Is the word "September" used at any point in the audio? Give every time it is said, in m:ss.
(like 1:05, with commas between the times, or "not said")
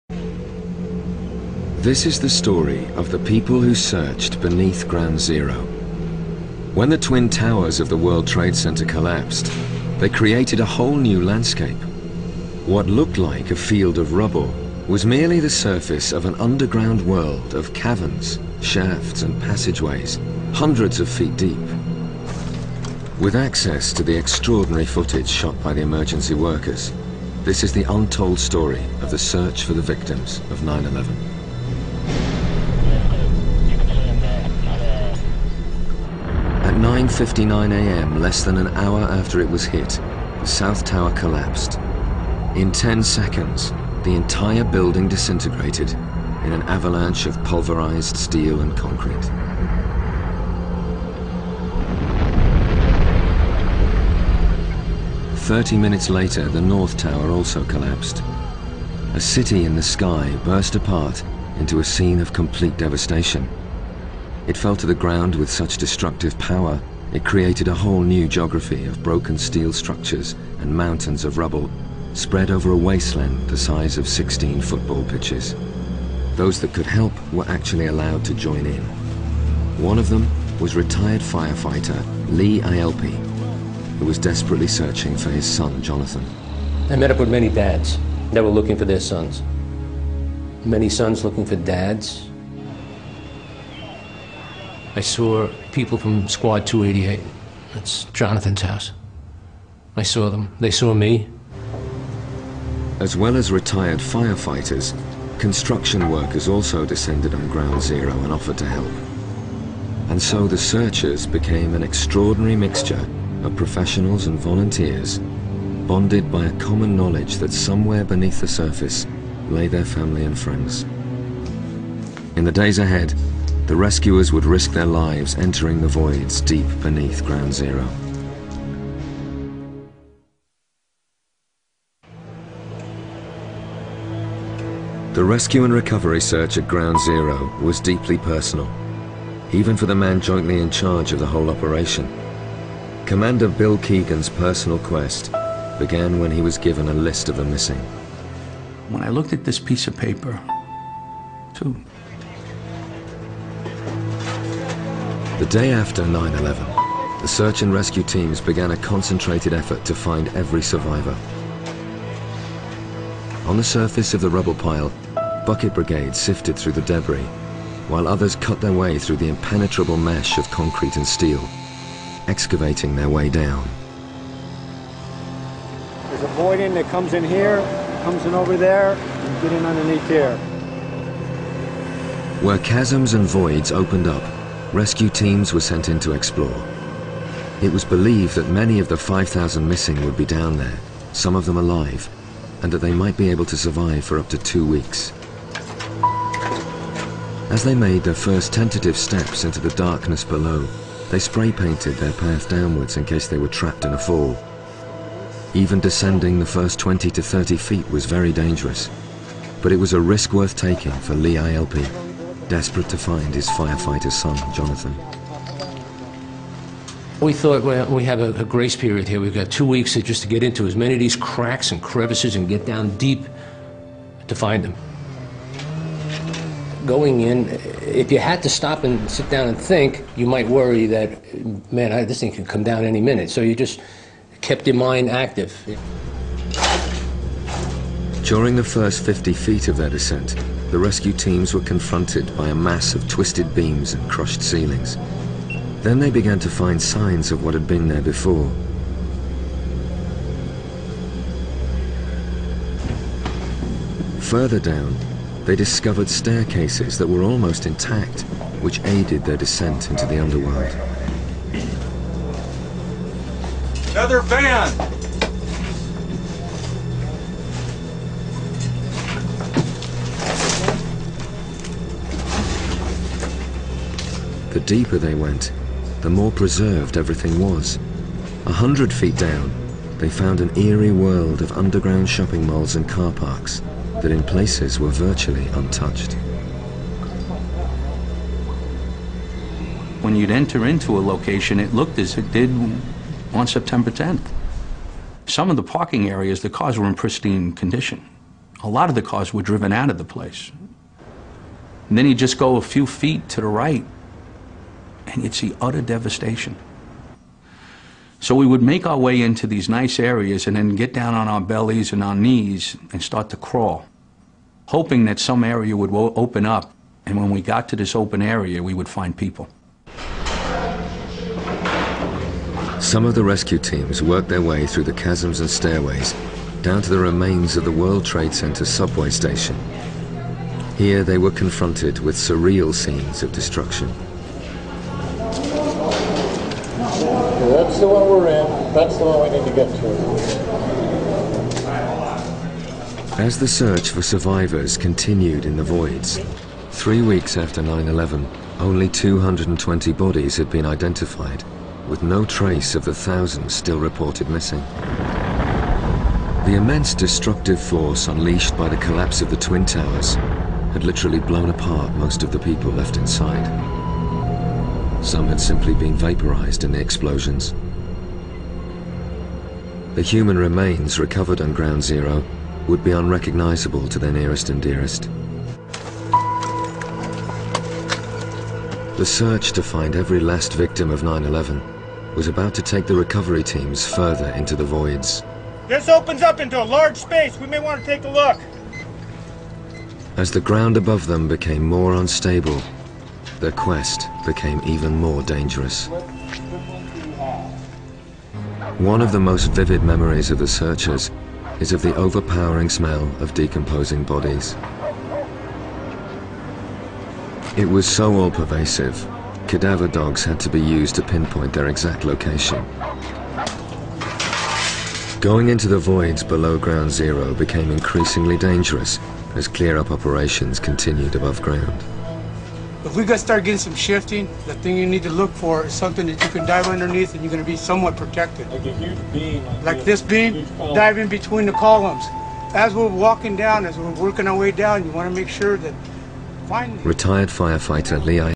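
4:53.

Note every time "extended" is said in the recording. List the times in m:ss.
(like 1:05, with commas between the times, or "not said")
not said.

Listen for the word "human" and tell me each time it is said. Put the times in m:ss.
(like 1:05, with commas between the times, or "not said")
6:10.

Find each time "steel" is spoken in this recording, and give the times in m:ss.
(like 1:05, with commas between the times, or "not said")
0:48, 1:09, 2:51.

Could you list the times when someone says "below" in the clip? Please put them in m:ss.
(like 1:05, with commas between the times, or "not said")
3:20, 6:56.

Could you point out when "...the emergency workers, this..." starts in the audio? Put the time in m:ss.
0:25.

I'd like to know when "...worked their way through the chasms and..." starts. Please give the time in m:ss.
5:24.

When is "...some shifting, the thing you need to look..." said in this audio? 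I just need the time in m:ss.
7:03.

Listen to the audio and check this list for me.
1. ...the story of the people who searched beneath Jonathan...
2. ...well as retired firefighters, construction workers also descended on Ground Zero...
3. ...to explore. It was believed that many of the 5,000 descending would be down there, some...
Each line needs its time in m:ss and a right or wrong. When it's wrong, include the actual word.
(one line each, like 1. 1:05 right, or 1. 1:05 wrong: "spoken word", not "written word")
1. 0:02 wrong: "Ground", not "Jonathan"
2. 1:43 right
3. 3:05 wrong: "missing", not "descending".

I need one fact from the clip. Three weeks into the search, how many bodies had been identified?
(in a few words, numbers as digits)
220.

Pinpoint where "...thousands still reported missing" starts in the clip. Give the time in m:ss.
5:52.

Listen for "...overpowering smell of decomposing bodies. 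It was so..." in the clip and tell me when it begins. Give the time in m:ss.
6:41.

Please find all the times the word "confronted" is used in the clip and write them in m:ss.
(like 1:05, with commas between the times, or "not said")
4:01, 5:31.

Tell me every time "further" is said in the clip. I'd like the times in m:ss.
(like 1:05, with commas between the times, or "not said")
4:14, 6:23.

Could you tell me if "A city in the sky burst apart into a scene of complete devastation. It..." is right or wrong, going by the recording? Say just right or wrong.
right.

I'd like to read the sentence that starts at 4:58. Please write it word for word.
A lot of the cars were driven out of the place.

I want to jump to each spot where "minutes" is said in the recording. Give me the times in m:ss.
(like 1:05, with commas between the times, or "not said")
0:55, 3:52.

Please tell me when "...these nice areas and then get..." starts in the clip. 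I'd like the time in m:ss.
5:09.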